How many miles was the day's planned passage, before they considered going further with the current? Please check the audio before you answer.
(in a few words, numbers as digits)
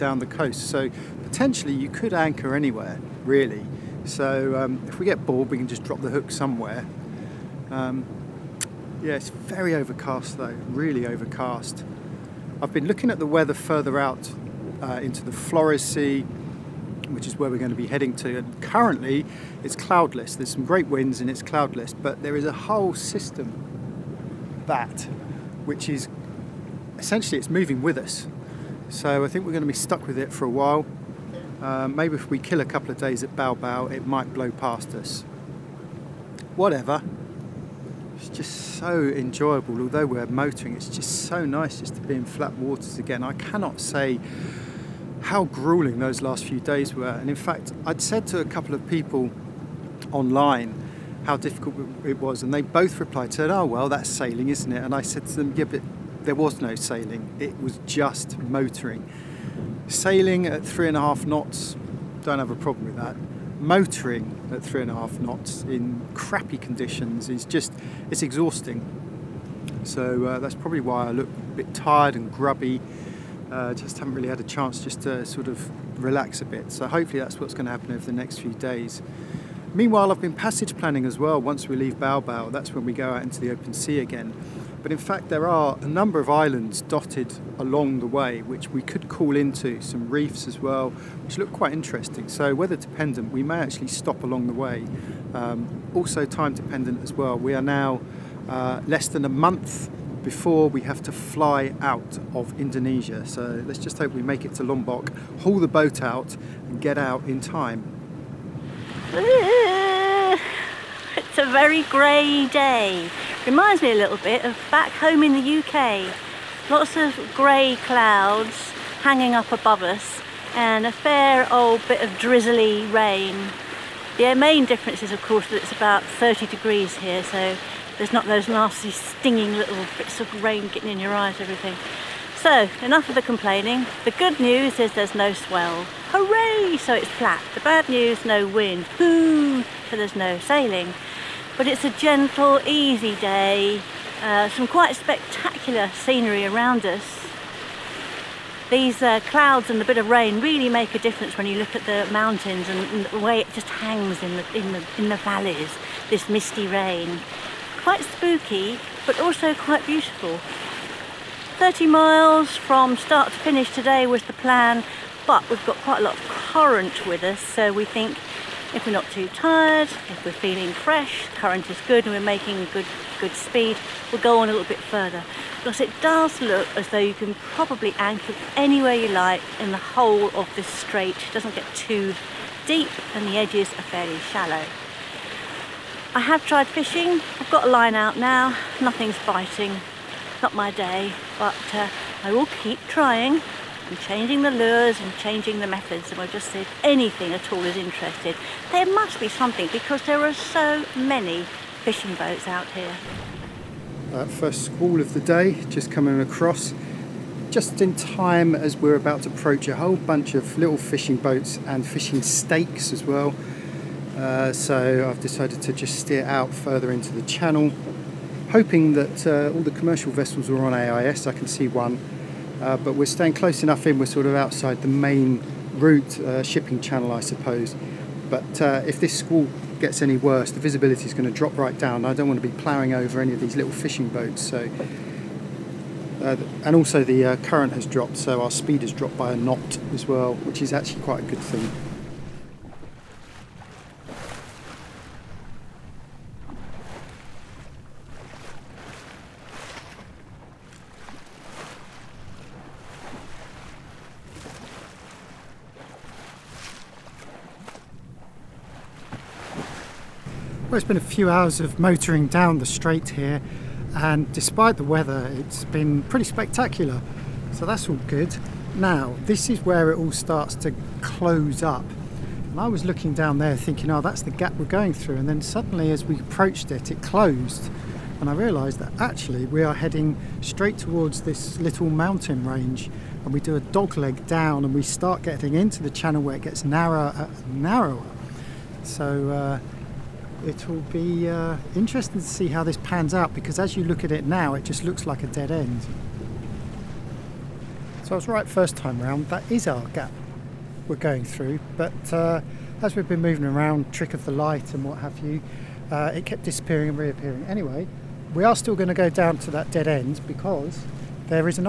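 30 miles.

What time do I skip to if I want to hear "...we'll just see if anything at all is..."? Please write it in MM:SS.
03:16.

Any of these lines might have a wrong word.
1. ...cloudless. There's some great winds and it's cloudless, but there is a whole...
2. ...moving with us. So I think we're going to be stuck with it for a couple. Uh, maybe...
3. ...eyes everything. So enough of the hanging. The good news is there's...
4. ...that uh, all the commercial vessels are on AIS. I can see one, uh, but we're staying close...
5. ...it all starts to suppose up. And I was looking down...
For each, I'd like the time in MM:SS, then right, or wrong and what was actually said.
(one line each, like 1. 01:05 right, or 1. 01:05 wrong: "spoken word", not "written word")
1. 00:19 right
2. 00:27 wrong: "while", not "couple"
3. 02:11 wrong: "complaining", not "hanging"
4. 03:38 right
5. 04:29 wrong: "close", not "suppose".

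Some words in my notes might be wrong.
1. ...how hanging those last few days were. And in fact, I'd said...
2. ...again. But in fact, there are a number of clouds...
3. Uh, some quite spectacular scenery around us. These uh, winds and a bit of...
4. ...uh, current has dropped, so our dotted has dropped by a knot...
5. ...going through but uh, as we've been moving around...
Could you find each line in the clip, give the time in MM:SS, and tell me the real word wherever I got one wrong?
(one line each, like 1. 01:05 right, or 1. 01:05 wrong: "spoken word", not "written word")
1. 00:45 wrong: "grueling", not "hanging"
2. 01:23 wrong: "islands", not "clouds"
3. 02:24 wrong: "clouds", not "winds"
4. 03:57 wrong: "speed", not "dotted"
5. 05:00 right.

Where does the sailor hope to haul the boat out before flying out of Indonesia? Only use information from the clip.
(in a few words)
Lombok.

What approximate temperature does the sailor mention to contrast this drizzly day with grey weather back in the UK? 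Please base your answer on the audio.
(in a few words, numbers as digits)
30 degrees.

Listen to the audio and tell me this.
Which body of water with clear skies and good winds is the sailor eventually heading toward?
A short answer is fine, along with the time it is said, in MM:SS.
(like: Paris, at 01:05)
Flores Sea, at 00:15.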